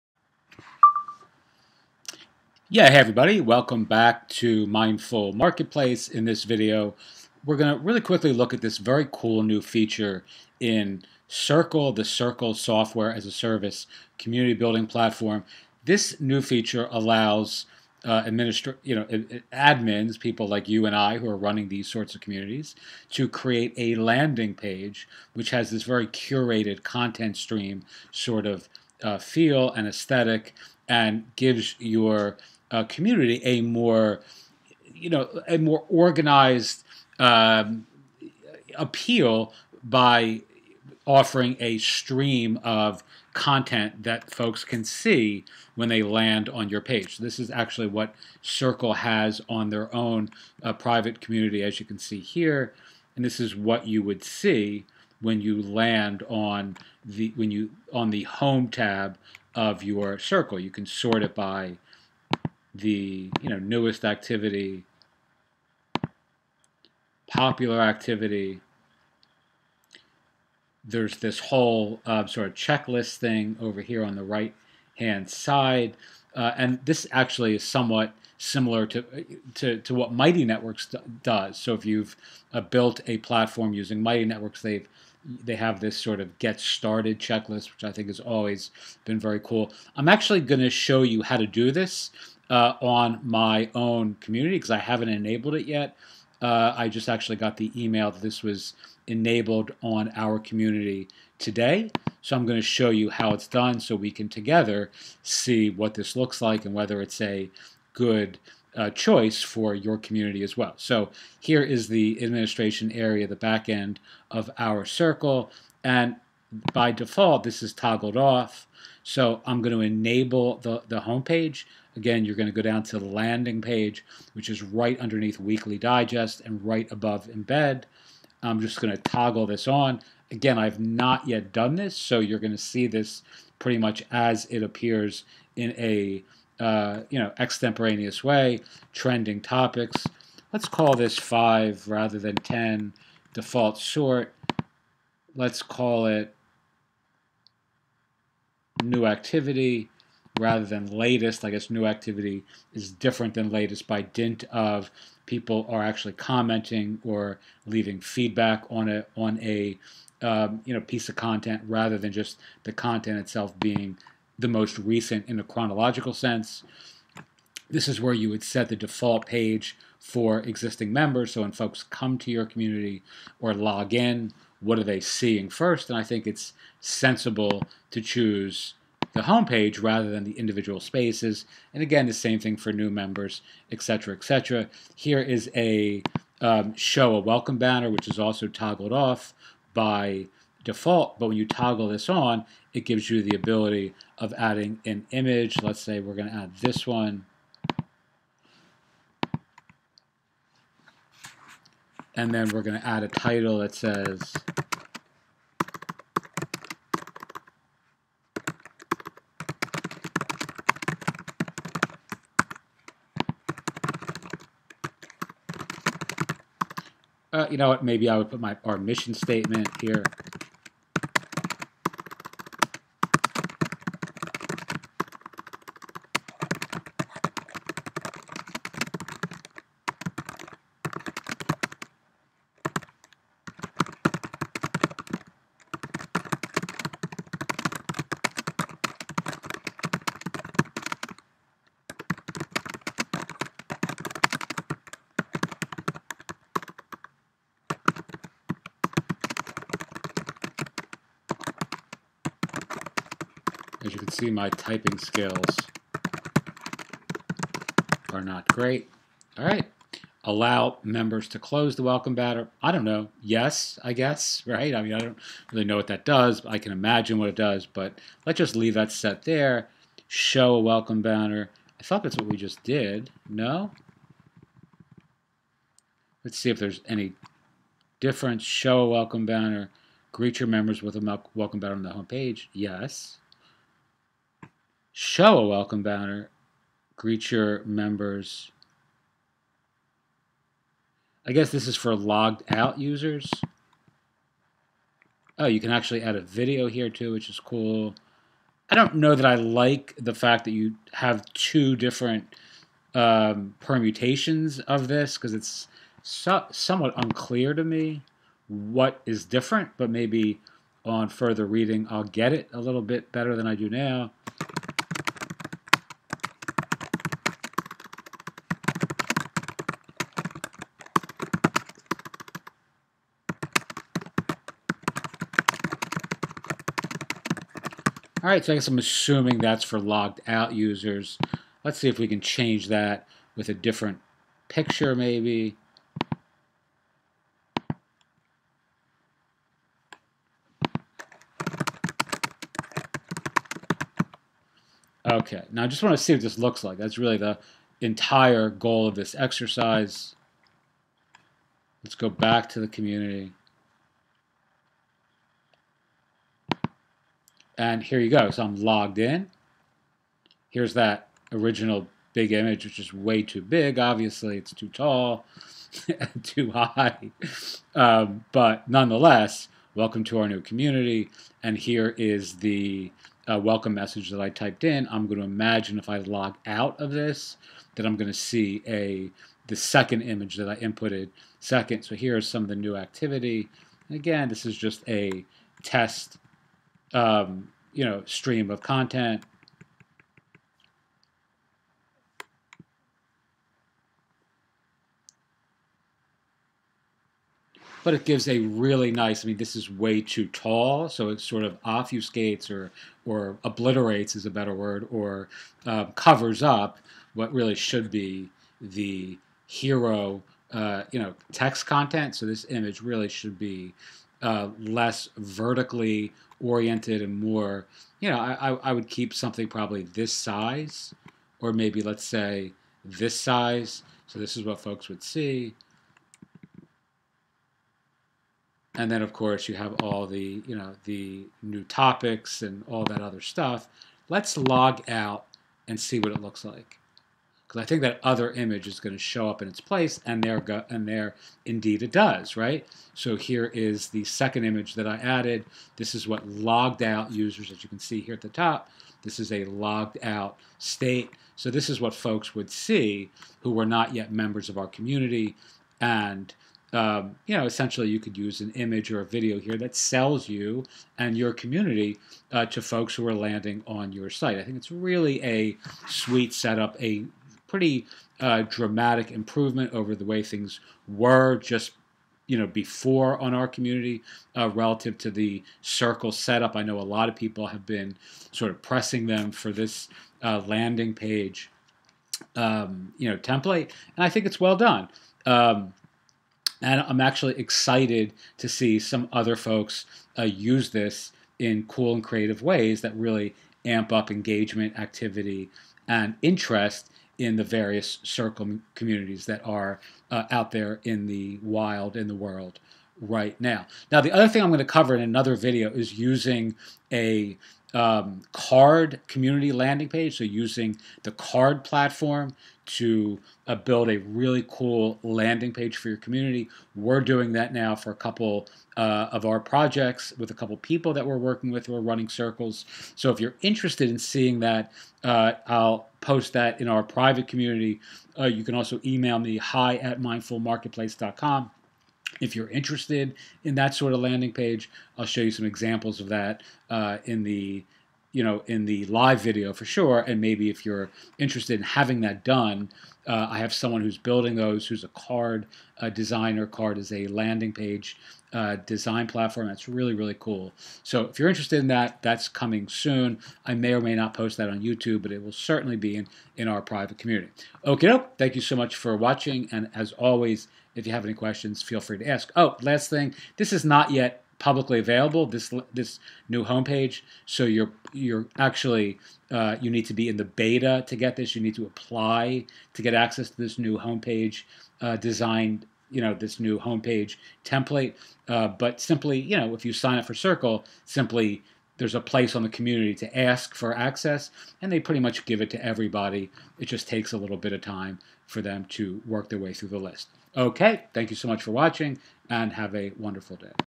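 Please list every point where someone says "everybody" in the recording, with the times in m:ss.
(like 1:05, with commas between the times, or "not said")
0:02, 9:45.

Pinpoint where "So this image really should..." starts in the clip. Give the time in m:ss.
6:52.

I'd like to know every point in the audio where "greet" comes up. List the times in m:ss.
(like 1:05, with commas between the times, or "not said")
4:40, 4:46.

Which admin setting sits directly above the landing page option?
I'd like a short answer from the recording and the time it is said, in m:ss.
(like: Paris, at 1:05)
Embed, at 2:07.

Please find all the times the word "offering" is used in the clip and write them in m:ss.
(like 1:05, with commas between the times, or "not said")
0:41.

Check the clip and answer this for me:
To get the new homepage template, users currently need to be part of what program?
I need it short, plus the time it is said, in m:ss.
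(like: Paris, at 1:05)
the beta, at 9:30.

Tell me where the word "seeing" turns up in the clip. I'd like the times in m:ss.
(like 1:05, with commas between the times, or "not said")
2:54, 8:43.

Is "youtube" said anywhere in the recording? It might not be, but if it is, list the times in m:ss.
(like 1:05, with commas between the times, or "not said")
9:14.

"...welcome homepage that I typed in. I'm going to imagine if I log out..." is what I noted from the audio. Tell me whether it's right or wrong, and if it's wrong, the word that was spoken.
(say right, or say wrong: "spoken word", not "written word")
wrong: "message", not "homepage".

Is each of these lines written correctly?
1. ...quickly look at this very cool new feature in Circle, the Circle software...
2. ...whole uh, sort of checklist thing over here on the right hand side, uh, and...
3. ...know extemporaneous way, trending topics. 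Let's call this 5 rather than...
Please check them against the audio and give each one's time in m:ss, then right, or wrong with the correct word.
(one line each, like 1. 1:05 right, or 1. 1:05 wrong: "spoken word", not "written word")
1. 0:07 right
2. 1:11 right
3. 2:17 right.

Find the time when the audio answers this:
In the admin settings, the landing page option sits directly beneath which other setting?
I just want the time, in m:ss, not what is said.
2:05.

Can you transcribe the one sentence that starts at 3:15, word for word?
Let's say we're going to add this one.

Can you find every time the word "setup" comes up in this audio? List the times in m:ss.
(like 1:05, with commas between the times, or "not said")
7:46, 7:56.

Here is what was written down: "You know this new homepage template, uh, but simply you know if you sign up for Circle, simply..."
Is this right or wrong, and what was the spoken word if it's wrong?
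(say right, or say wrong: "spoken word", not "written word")
right.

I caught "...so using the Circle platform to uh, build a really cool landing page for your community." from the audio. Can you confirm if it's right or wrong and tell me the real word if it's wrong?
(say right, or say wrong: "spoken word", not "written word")
wrong: "Carrd", not "Circle".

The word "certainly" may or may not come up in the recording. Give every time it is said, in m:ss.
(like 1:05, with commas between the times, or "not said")
9:15.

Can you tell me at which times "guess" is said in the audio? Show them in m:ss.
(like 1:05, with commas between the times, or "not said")
4:23, 4:51, 5:28.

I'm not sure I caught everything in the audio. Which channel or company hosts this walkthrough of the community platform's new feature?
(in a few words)
Mindful Marketplace.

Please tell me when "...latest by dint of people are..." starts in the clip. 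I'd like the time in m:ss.
2:33.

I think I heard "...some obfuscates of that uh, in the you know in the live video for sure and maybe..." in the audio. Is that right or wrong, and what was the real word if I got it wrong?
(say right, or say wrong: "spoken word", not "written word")
wrong: "examples", not "obfuscates".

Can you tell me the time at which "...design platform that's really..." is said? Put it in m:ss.
9:08.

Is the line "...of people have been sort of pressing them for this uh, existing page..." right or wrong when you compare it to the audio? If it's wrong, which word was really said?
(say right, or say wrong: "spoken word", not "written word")
wrong: "landing", not "existing".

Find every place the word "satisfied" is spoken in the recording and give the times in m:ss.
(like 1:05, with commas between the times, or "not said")
not said.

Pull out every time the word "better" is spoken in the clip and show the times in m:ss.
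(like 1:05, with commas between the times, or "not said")
5:13, 6:44.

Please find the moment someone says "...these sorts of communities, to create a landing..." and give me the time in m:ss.
0:21.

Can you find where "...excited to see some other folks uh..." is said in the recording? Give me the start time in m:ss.
8:07.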